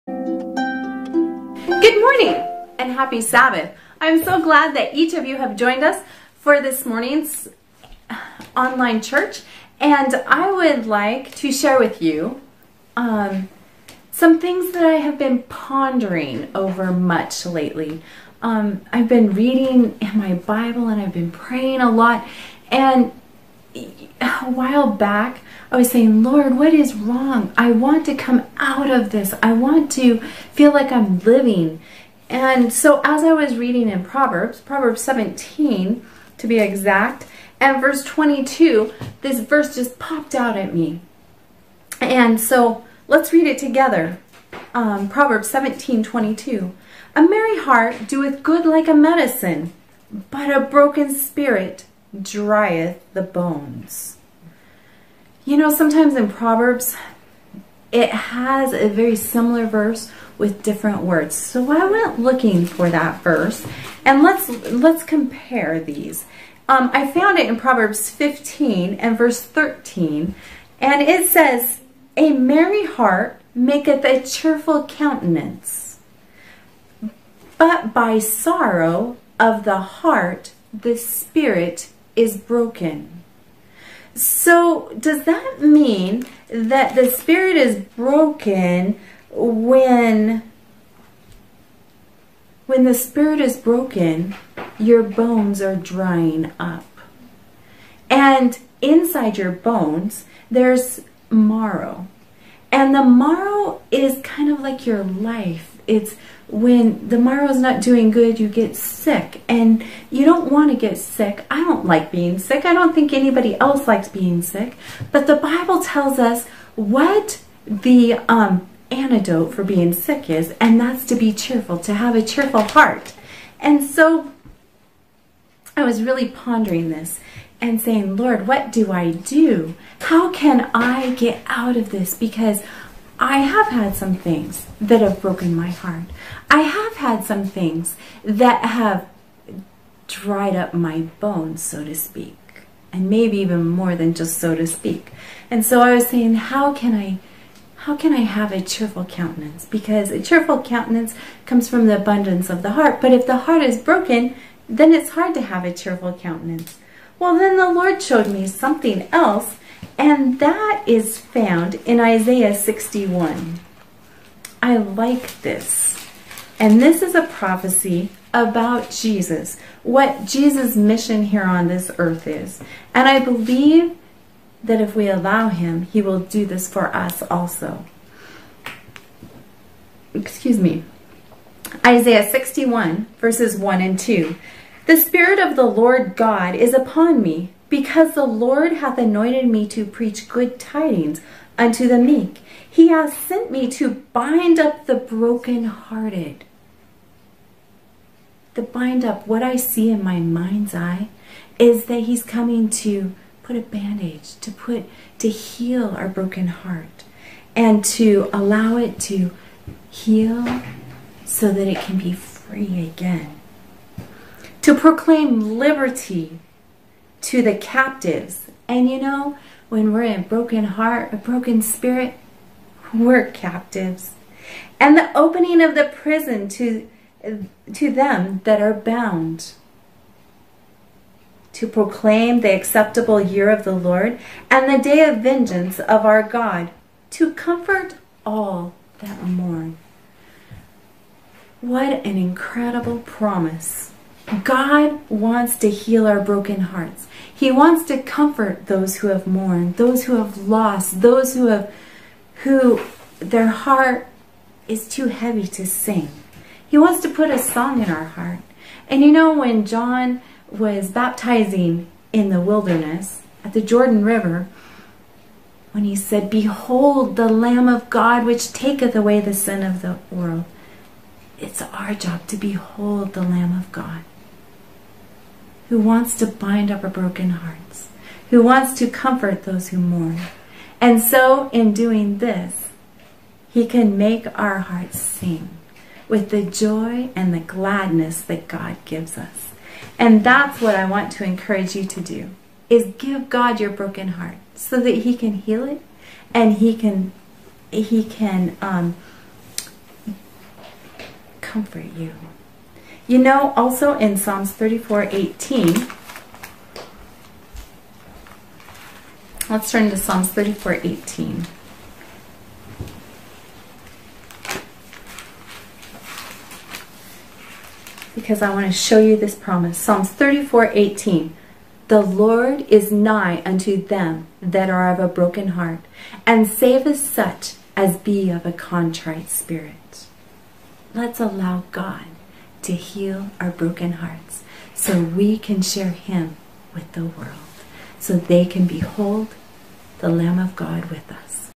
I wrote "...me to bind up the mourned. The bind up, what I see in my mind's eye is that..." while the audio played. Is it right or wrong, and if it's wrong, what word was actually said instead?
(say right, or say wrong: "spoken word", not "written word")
wrong: "brokenhearted", not "mourned".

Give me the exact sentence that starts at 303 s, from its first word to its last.
You know, also in Psalms 34, 18, let's turn to Psalms 34, 18.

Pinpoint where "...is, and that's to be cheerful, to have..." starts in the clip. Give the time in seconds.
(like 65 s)
120 s.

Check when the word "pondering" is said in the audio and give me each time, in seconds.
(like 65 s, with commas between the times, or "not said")
15 s, 126 s.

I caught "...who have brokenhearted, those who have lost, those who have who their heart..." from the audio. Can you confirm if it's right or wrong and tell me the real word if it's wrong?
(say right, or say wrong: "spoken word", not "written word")
wrong: "mourned", not "brokenhearted".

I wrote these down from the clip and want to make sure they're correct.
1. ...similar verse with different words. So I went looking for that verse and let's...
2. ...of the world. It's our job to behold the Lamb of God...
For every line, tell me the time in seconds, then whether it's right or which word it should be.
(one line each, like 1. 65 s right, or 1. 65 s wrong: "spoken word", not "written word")
1. 59 s right
2. 269 s right.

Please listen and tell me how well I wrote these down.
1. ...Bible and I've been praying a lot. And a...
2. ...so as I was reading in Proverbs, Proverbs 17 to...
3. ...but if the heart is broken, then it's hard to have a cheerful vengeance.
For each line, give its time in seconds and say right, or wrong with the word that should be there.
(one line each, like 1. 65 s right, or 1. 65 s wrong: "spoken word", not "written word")
1. 20 s right
2. 32 s right
3. 153 s wrong: "countenance", not "vengeance".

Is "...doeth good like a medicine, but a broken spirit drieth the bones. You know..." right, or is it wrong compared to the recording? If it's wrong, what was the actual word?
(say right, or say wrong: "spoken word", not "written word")
right.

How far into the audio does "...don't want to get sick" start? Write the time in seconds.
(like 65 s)
110 s.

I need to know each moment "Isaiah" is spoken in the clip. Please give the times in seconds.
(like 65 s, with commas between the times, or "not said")
161 s, 181 s.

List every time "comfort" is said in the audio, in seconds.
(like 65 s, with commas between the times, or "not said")
237 s, 248 s, 278 s, 301 s.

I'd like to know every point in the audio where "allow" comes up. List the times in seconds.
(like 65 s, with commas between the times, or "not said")
175 s, 208 s, 331 s.